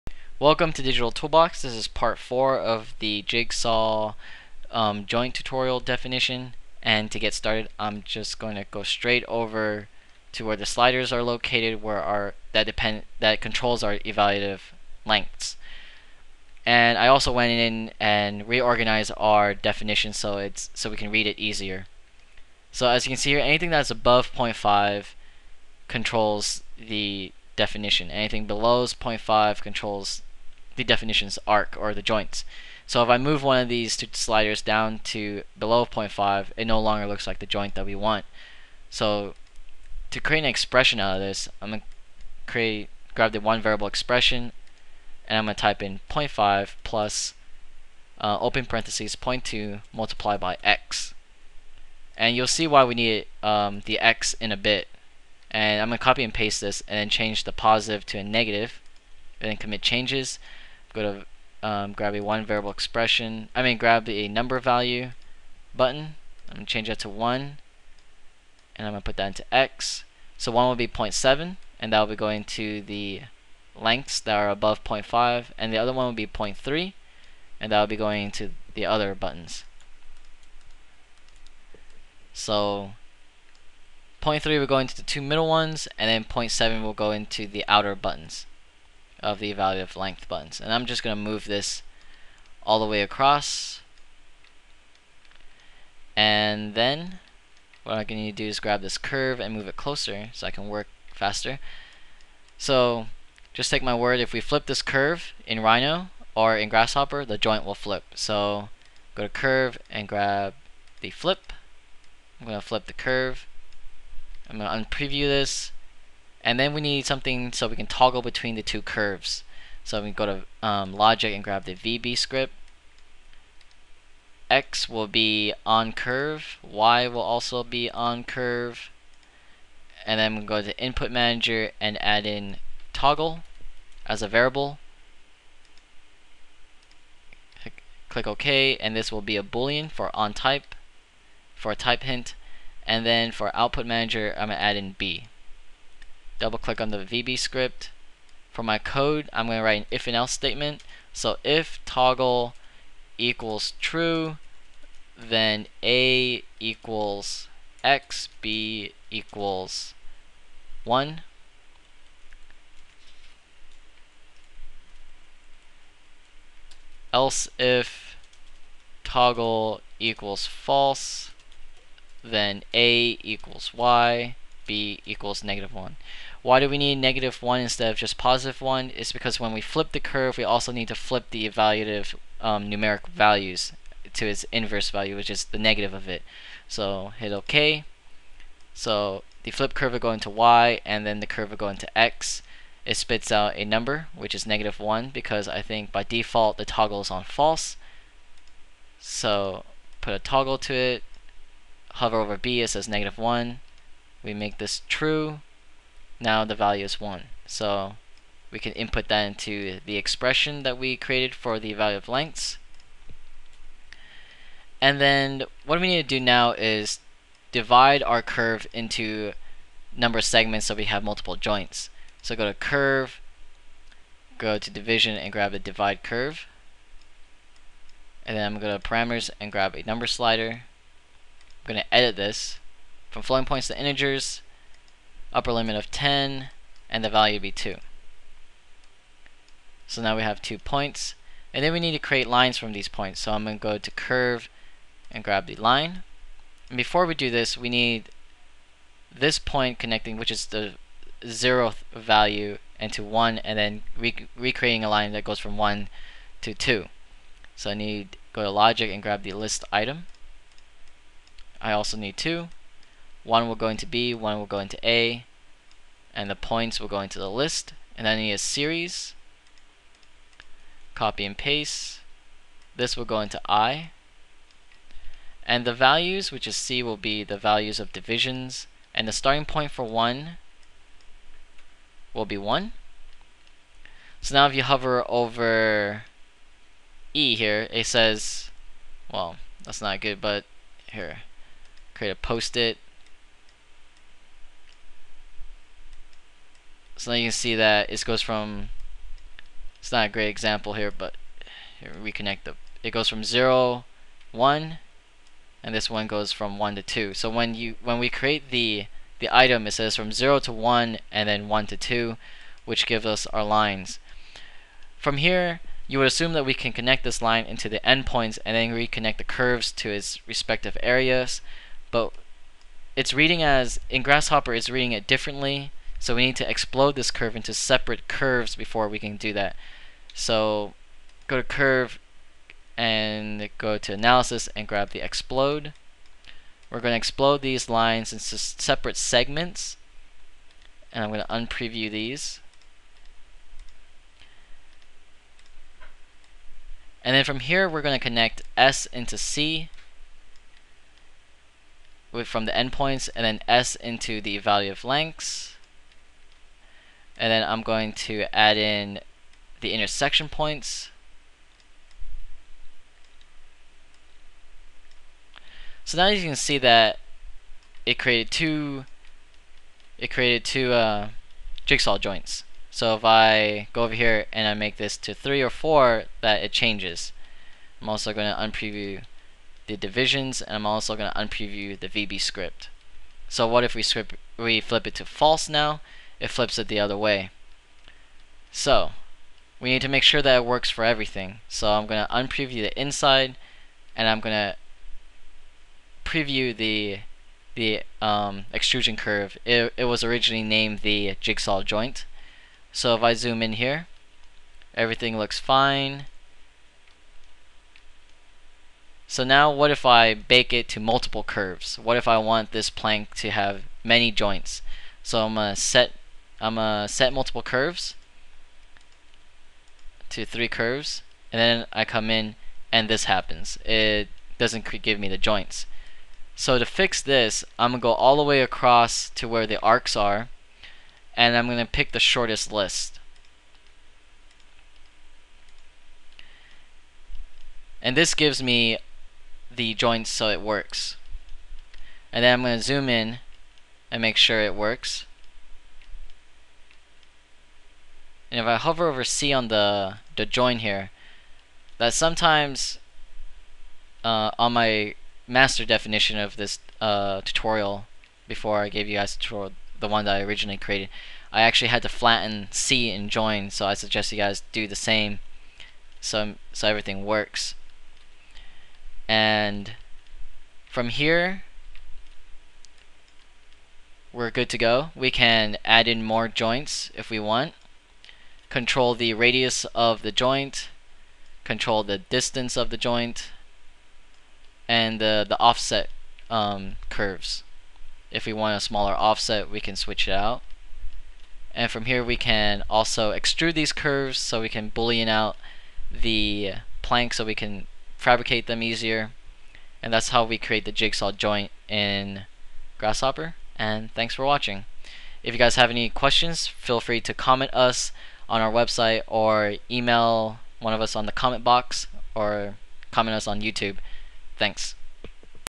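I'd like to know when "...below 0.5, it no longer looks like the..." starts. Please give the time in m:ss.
0:35.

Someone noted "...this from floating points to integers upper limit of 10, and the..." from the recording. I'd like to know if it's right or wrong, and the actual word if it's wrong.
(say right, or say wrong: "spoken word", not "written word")
right.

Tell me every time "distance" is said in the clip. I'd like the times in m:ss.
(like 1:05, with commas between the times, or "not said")
8:01.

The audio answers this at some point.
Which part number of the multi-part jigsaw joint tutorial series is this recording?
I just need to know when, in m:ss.
0:01.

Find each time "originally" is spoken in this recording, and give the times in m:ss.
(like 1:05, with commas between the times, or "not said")
6:40, 7:40.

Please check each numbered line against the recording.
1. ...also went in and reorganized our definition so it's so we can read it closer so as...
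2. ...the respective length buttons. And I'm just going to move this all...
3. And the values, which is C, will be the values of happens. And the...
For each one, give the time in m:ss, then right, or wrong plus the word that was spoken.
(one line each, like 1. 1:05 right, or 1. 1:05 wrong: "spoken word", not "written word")
1. 0:17 wrong: "easier", not "closer"
2. 1:29 wrong: "evaluative", not "respective"
3. 4:35 wrong: "divisions", not "happens".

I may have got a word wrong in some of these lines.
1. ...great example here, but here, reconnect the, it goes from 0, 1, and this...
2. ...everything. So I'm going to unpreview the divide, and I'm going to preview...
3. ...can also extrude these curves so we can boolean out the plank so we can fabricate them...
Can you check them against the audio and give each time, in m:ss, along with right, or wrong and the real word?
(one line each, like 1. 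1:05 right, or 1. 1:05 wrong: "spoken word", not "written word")
1. 5:00 right
2. 6:30 wrong: "inside", not "divide"
3. 8:12 right.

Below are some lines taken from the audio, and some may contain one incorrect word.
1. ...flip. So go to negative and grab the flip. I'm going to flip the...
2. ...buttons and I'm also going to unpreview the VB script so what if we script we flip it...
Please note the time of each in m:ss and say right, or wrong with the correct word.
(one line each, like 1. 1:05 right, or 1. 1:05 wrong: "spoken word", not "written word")
1. 1:47 wrong: "curve", not "negative"
2. 6:19 wrong: "divisions", not "buttons".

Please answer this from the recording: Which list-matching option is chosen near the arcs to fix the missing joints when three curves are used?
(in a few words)
shortest list.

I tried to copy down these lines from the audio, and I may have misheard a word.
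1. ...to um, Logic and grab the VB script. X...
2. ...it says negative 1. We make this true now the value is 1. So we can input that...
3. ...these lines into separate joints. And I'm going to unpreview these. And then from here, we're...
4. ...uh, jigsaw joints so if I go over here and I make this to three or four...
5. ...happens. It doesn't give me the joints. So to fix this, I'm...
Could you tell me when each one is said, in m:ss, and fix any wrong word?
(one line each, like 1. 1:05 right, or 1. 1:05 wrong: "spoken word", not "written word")
1. 2:00 right
2. 3:22 right
3. 5:37 wrong: "segments", not "joints"
4. 6:10 right
5. 7:03 right.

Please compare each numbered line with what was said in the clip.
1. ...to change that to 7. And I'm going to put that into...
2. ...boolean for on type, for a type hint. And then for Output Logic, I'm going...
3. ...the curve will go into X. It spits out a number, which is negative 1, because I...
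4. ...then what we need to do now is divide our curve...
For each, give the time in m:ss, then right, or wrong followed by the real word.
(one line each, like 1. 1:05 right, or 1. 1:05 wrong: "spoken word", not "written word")
1. 1:06 wrong: "1", not "7"
2. 2:19 wrong: "Manager", not "Logic"
3. 3:11 right
4. 3:35 right.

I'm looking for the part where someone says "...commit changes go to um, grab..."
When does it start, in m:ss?
0:59.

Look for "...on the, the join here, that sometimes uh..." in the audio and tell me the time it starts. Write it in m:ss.
7:29.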